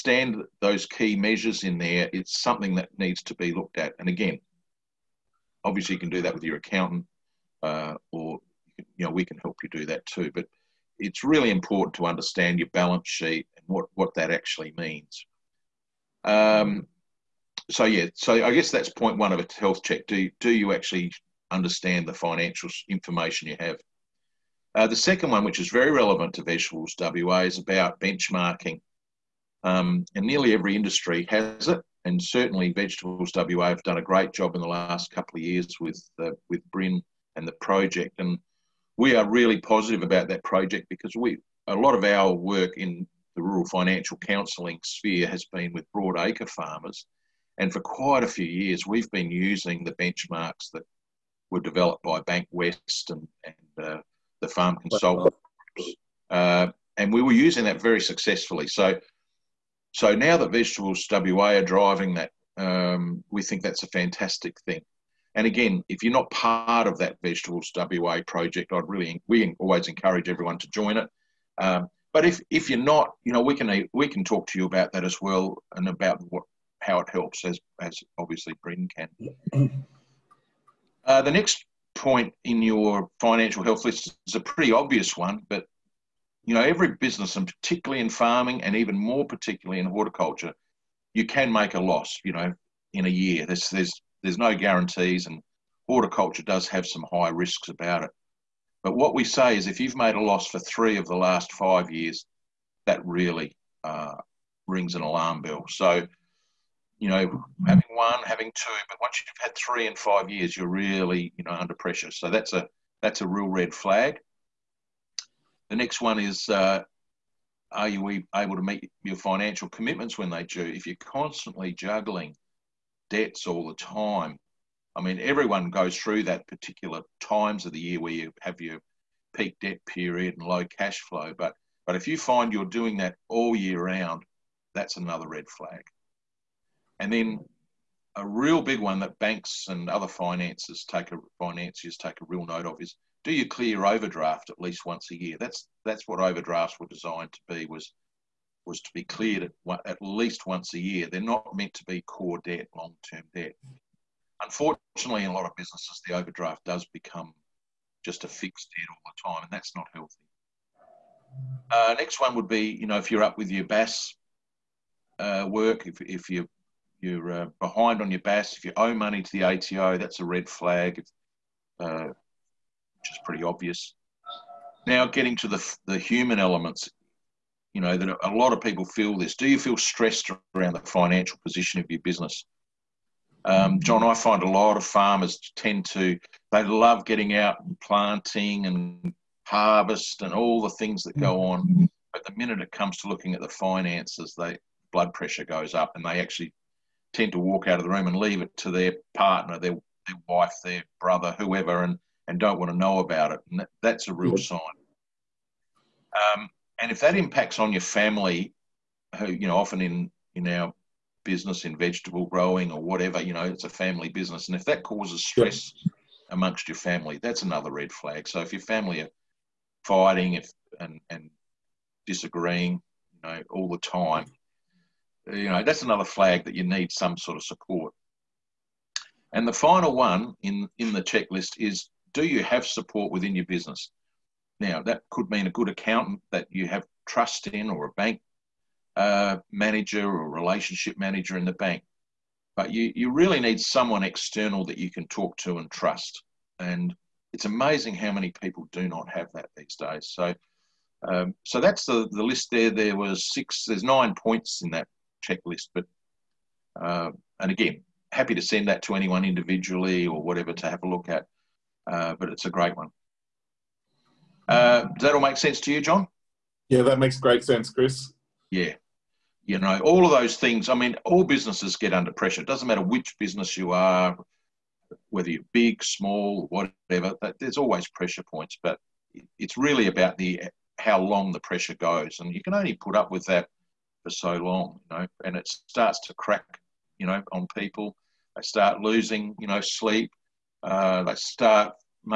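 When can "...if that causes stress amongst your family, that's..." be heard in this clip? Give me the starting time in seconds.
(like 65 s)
214 s.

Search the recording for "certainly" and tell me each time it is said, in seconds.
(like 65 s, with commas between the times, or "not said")
32 s.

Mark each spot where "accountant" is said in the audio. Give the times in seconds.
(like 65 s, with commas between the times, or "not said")
6 s, 235 s.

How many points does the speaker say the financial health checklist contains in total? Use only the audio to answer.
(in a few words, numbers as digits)
9.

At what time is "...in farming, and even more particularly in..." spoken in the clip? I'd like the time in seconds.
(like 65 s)
88 s.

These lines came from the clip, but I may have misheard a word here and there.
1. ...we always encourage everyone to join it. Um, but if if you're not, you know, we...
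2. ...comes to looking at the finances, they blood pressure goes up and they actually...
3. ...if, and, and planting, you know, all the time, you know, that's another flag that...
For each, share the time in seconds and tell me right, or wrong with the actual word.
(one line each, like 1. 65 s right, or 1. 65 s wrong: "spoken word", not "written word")
1. 69 s right
2. 192 s right
3. 220 s wrong: "disagreeing", not "planting".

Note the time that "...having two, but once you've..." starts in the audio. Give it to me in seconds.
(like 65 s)
108 s.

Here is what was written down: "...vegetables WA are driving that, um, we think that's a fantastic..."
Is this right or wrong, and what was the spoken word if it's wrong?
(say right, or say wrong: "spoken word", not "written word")
right.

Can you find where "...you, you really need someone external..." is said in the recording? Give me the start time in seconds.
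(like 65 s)
242 s.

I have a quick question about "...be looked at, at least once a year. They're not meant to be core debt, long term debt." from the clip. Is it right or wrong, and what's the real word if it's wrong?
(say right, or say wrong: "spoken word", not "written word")
wrong: "cleared", not "looked".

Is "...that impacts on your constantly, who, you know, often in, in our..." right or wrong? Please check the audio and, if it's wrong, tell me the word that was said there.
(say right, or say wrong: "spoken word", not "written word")
wrong: "family", not "constantly".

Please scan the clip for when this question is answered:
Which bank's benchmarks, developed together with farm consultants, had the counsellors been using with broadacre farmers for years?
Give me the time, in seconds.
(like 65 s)
52 s.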